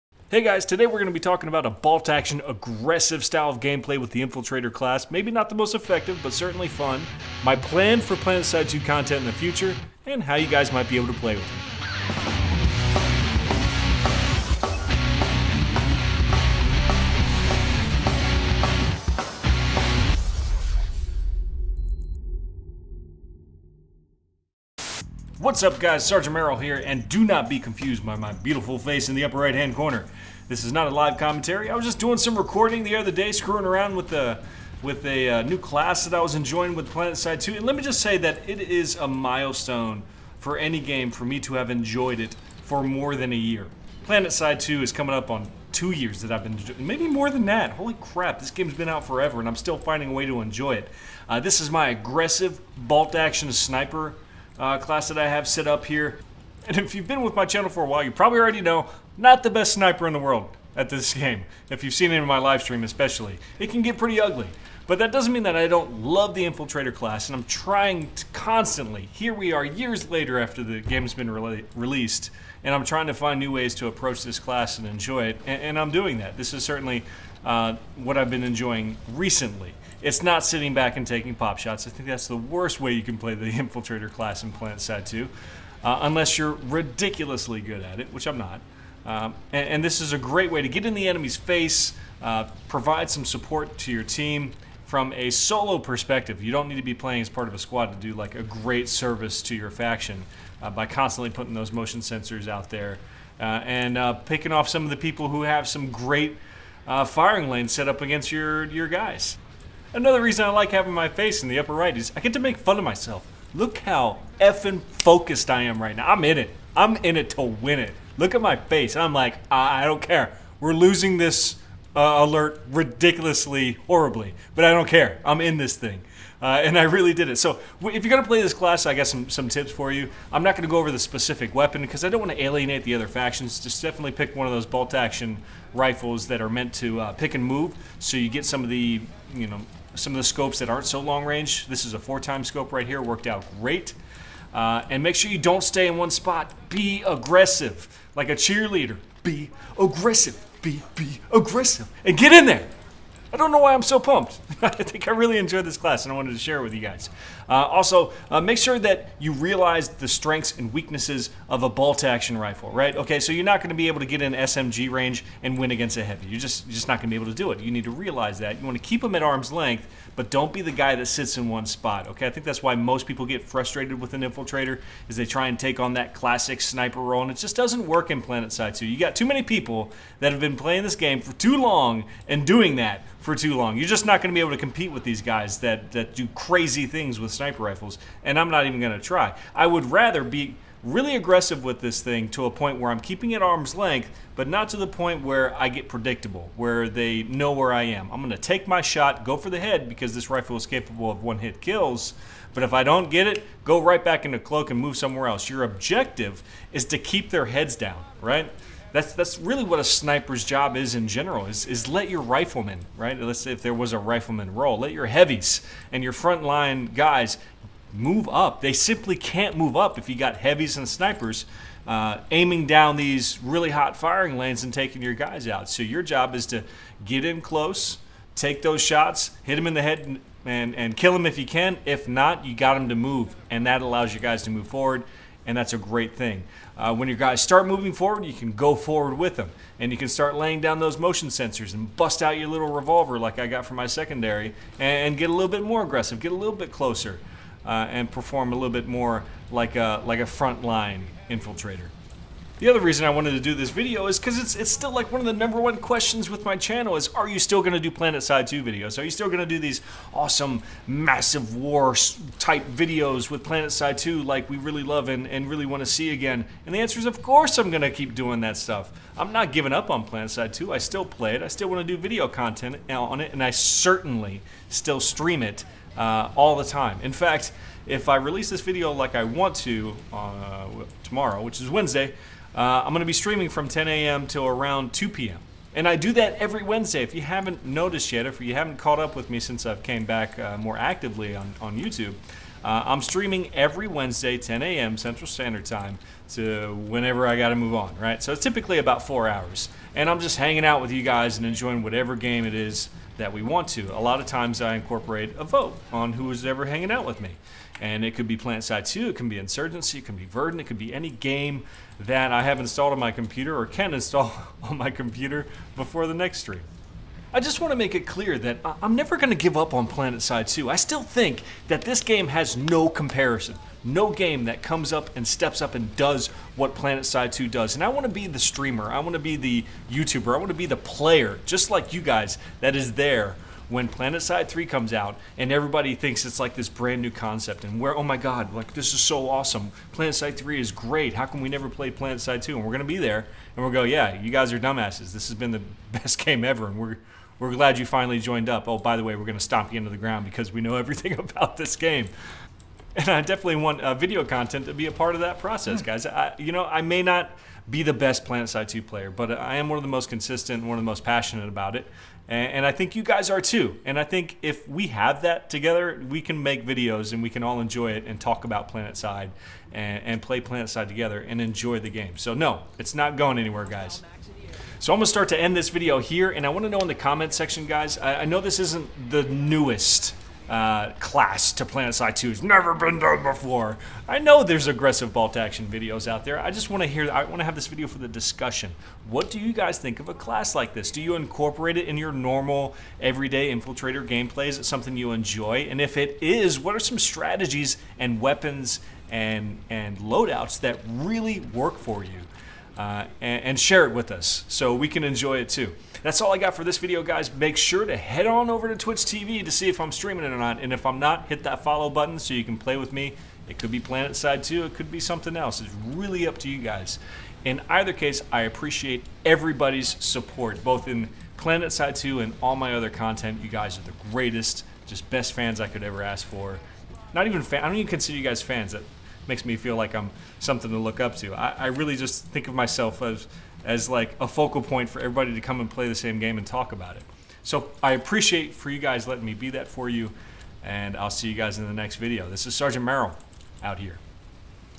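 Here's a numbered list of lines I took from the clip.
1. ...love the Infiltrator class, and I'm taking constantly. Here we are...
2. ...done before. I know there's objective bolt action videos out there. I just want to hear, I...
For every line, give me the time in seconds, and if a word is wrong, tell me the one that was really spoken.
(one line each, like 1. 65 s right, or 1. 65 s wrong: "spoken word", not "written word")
1. 66 s wrong: "trying", not "taking"
2. 382 s wrong: "aggressive", not "objective".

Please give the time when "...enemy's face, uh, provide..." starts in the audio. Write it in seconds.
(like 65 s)
91 s.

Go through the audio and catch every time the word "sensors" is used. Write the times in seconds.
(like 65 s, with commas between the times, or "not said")
102 s, 241 s.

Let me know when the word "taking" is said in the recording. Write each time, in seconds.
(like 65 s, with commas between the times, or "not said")
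81 s, 224 s.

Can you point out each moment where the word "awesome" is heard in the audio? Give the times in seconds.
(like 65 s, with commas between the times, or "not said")
260 s, 339 s.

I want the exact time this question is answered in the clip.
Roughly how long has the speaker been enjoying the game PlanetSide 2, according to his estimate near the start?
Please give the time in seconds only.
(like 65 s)
45 s.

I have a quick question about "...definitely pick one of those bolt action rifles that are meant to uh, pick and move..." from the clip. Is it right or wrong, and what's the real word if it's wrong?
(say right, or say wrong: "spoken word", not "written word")
right.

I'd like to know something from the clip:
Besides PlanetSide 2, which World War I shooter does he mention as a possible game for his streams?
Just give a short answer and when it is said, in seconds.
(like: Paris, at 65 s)
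Verdun, at 310 s.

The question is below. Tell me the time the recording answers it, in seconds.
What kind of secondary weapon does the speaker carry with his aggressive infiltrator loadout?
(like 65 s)
242 s.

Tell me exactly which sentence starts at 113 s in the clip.
Look how effing focused I am right now.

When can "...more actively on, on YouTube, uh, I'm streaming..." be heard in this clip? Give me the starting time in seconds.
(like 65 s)
290 s.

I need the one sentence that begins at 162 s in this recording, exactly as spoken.
Okay, so you're not going to be able to get in SMG range and win against a heavy.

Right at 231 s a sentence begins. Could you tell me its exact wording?
If not, you got them to move, and that allows your guys to move forward and that's a great thing.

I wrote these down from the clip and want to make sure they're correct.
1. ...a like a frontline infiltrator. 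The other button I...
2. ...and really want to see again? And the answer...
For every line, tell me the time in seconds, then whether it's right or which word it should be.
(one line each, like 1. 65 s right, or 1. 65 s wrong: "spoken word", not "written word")
1. 249 s wrong: "reason", not "button"
2. 265 s right.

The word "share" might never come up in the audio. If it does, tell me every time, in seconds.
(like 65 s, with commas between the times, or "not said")
156 s, 403 s.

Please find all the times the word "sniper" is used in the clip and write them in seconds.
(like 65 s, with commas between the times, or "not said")
53 s, 59 s, 176 s, 187 s, 209 s, 220 s.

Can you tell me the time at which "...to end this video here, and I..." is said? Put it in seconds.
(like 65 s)
375 s.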